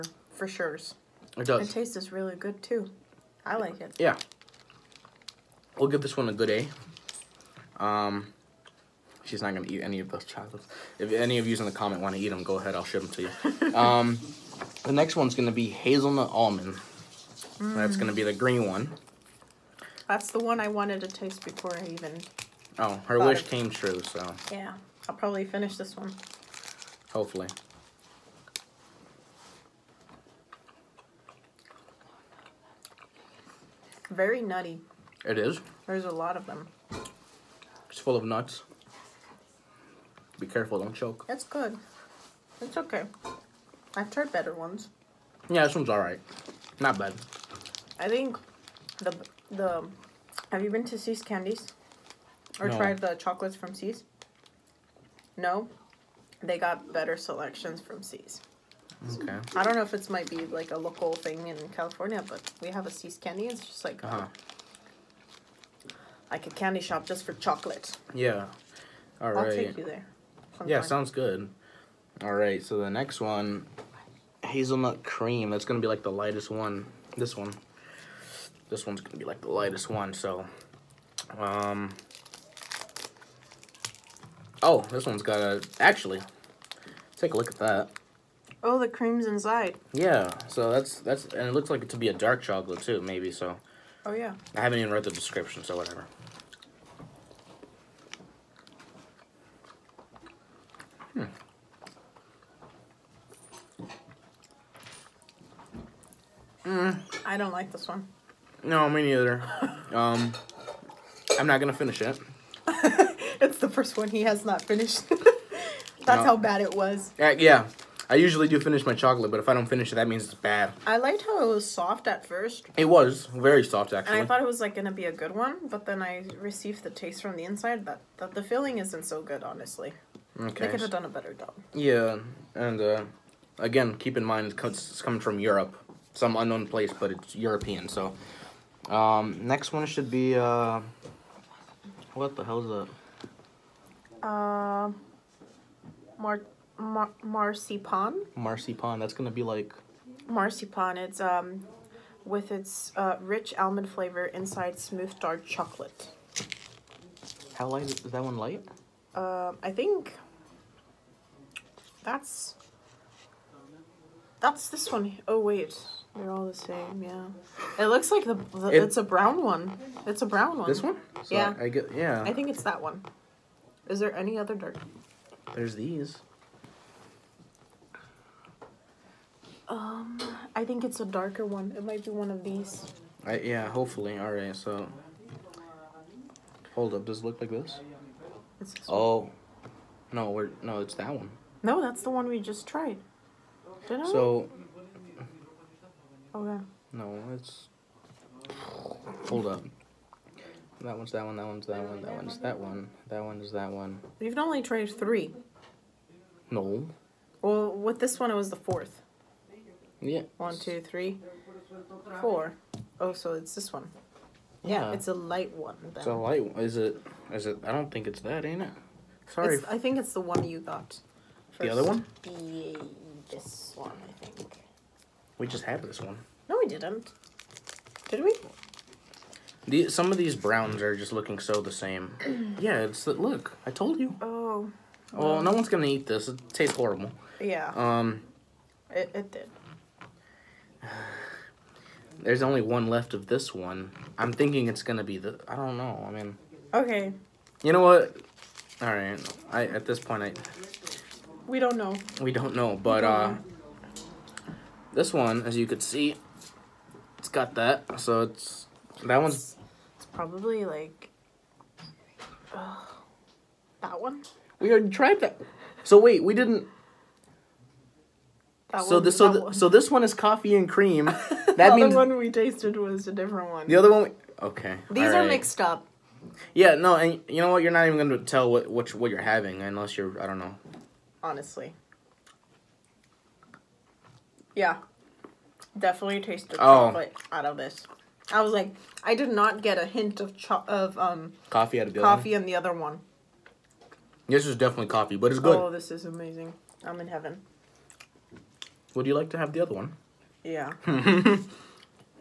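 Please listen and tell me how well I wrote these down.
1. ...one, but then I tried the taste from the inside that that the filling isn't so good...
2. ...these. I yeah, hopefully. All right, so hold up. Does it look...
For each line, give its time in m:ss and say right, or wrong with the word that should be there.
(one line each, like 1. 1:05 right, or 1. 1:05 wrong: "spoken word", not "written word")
1. 2:05 wrong: "received", not "tried"
2. 3:02 right.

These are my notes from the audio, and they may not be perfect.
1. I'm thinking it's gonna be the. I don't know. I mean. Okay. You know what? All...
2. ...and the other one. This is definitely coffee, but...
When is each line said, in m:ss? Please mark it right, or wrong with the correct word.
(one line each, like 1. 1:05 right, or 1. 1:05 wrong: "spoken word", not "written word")
1. 4:04 right
2. 4:52 right.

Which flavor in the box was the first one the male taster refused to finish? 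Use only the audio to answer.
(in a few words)
Hazelnut cream.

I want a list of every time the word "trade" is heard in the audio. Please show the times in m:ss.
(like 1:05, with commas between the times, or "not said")
3:24.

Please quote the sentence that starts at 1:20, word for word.
So, um, oh, this one's got a actually.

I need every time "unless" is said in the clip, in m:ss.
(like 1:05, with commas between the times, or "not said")
4:39.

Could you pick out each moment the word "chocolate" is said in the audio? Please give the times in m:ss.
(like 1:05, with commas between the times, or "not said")
0:10, 0:53, 1:07, 1:32, 1:58, 2:35, 4:46.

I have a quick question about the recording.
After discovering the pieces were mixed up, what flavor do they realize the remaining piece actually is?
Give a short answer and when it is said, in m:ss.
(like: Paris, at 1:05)
Coffee and cream, at 4:30.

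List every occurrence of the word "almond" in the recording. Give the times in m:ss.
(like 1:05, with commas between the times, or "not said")
0:16, 2:33.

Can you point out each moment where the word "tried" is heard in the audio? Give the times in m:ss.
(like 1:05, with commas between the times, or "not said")
0:44, 0:52, 3:12, 4:24.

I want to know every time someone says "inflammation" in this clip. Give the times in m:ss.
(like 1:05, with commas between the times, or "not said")
not said.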